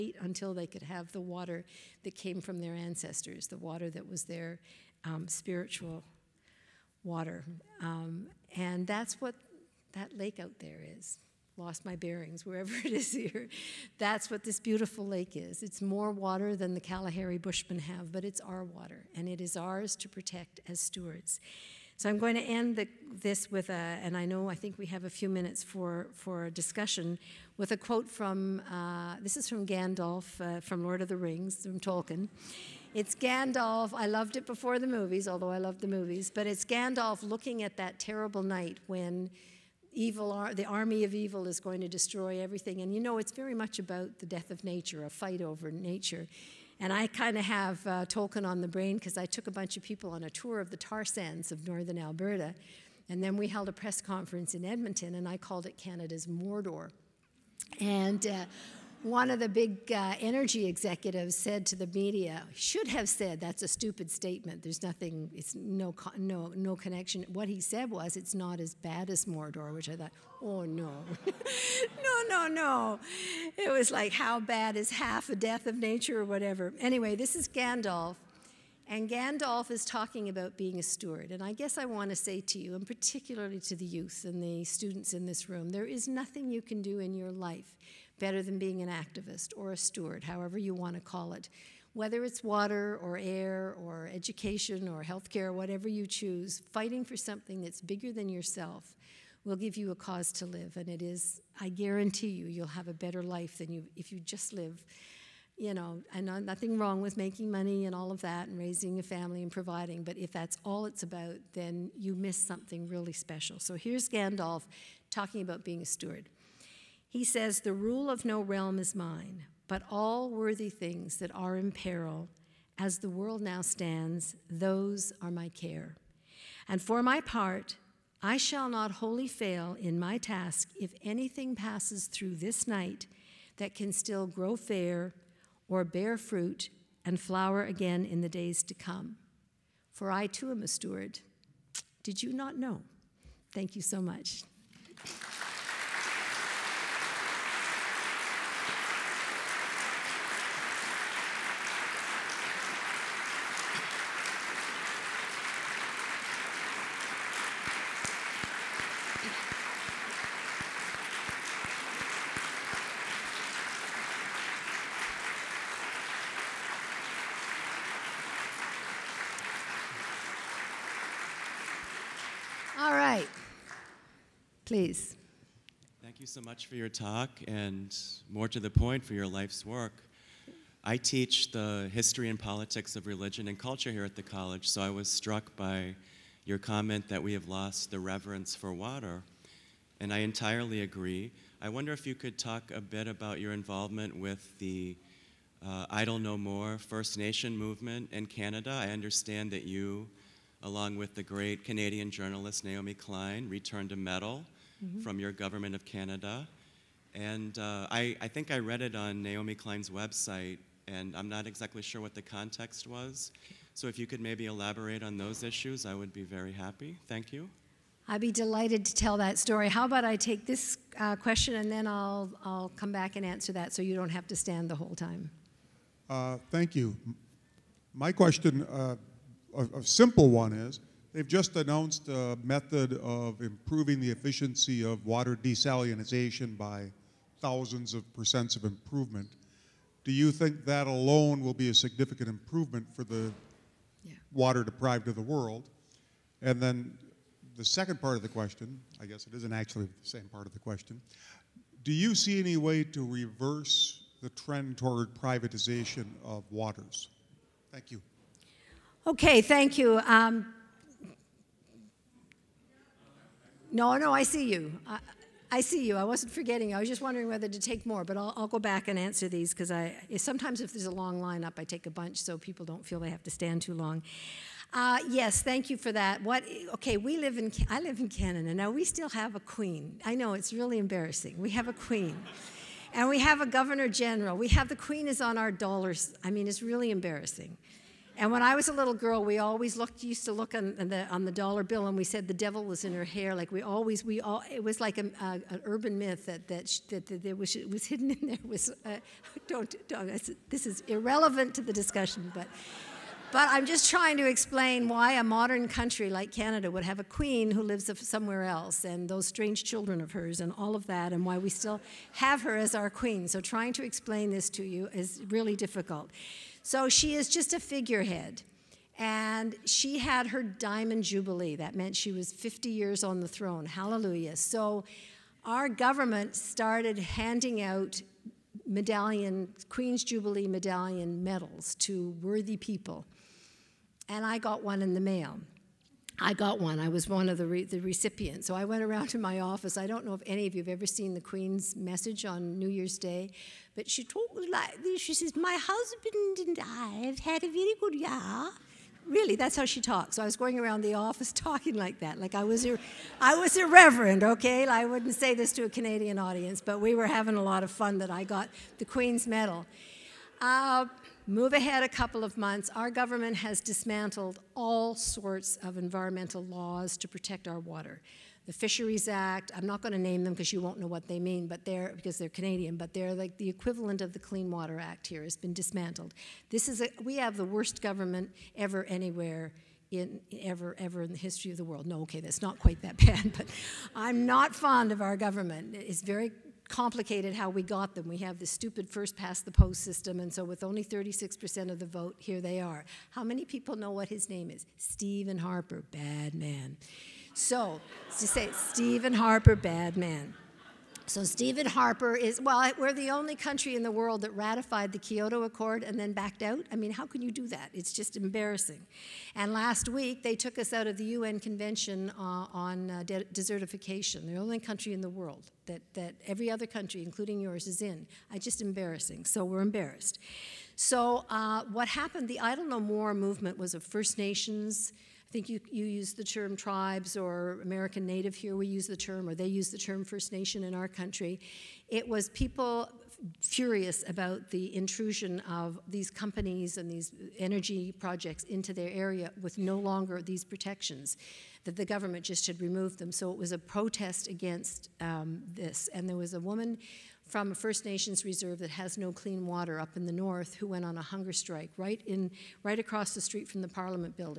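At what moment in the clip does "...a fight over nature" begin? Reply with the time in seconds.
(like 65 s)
45 s.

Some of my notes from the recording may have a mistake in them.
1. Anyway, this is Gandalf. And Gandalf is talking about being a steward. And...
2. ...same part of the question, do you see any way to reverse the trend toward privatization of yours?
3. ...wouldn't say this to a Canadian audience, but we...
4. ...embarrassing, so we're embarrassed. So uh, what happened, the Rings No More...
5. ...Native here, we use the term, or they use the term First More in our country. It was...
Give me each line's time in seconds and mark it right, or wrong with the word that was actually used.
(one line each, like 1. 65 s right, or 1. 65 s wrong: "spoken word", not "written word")
1. 76 s right
2. 250 s wrong: "waters", not "yours"
3. 354 s right
4. 418 s wrong: "Idle", not "Rings"
5. 428 s wrong: "Nation", not "More".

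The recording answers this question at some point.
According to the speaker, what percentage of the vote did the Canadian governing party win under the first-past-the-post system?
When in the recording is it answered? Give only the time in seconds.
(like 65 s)
390 s.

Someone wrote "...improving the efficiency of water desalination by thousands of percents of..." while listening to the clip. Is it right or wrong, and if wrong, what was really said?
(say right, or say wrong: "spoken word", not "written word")
right.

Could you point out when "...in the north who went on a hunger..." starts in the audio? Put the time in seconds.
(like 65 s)
449 s.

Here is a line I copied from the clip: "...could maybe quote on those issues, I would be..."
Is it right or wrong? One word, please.
wrong.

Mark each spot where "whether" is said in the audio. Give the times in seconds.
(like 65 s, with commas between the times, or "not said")
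91 s, 267 s.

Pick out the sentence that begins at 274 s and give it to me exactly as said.
Uh, yes, thank you for that.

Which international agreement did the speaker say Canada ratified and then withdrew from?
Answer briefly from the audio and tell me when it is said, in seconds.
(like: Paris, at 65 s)
Kyoto Accord, at 404 s.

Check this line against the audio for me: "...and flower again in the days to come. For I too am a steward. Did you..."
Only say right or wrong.
right.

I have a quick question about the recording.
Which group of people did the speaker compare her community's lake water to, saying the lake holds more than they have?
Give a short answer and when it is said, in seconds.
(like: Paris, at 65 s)
Kalahari Bushmen, at 16 s.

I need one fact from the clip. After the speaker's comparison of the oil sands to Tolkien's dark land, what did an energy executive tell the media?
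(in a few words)
It's not as bad as Mordor.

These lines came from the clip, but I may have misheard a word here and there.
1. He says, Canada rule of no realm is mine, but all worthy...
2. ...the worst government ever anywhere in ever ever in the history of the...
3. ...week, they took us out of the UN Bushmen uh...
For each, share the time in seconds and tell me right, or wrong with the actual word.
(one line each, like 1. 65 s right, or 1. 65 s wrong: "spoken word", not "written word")
1. 117 s wrong: "The", not "Canada"
2. 377 s right
3. 409 s wrong: "Convention", not "Bushmen".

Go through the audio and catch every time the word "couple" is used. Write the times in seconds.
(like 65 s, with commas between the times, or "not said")
361 s.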